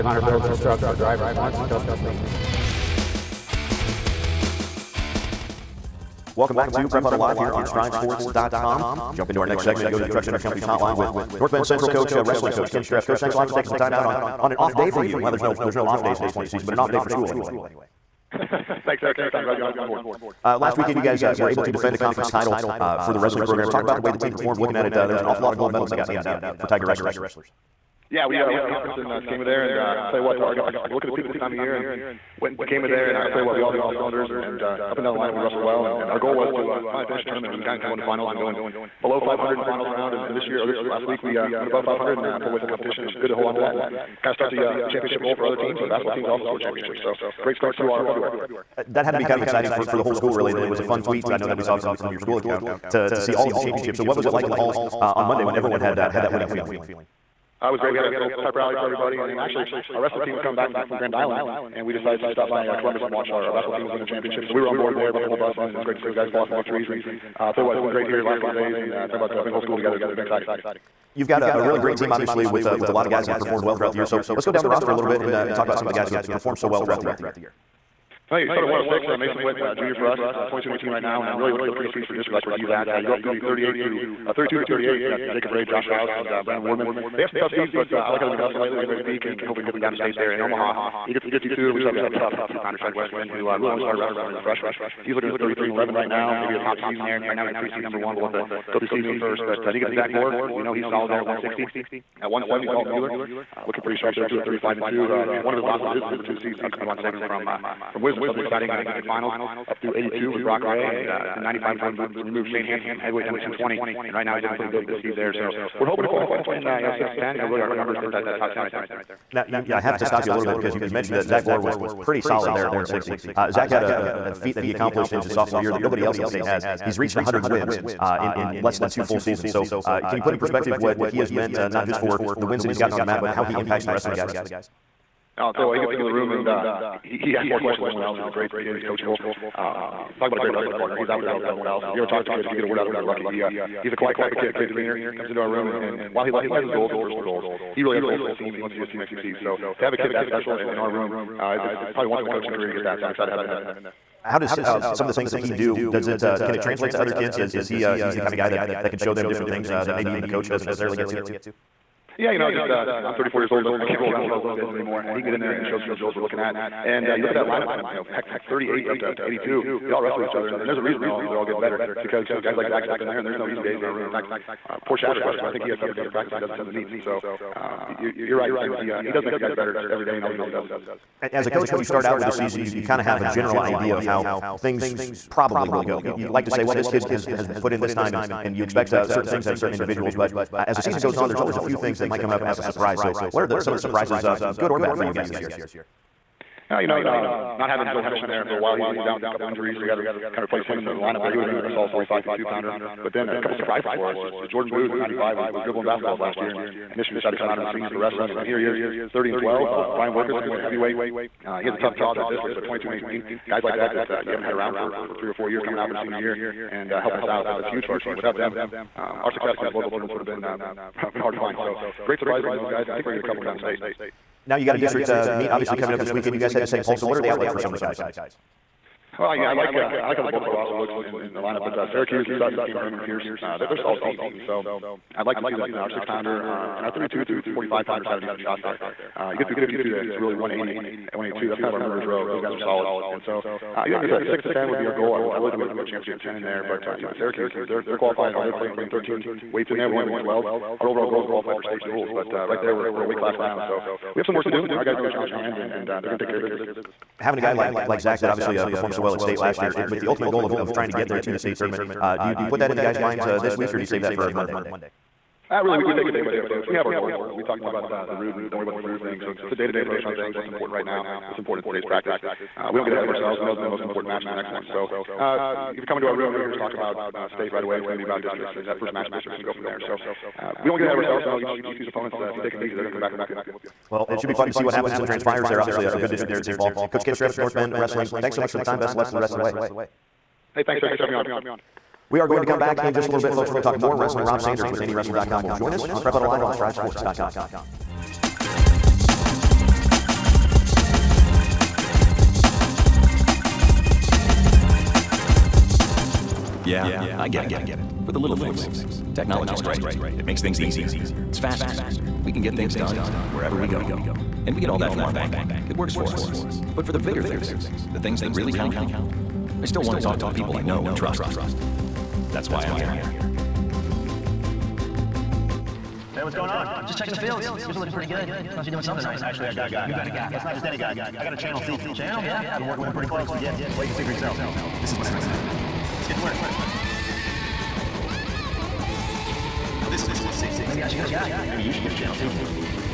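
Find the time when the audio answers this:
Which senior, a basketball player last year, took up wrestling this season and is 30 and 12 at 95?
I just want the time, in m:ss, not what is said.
3:24.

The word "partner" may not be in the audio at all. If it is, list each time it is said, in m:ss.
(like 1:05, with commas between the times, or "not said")
2:20.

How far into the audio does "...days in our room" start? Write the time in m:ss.
2:53.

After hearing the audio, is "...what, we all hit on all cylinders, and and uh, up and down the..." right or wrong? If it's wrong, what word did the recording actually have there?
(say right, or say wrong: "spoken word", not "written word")
right.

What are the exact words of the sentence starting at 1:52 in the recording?
And we moved Shane Hanson from heavyweight down to 220, and right now he's looking pretty good this seed there.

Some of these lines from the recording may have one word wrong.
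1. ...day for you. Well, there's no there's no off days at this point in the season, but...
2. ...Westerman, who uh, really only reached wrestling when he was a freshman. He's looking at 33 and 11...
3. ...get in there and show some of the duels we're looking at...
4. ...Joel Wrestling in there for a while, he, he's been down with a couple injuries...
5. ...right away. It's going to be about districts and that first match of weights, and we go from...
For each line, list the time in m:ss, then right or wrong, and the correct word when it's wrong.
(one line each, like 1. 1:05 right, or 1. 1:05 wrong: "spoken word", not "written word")
1. 0:14 right
2. 1:32 wrong: "started", not "reached"
3. 2:45 wrong: "drills", not "duels"
4. 3:17 wrong: "Hennish", not "Wrestling"
5. 4:37 wrong: "districts", not "weights".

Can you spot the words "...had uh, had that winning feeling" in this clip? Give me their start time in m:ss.
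0:55.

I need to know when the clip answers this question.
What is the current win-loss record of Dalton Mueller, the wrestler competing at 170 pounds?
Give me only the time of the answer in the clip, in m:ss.
1:44.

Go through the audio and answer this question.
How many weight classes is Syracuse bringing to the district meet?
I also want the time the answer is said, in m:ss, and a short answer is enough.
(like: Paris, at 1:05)
13, at 4:08.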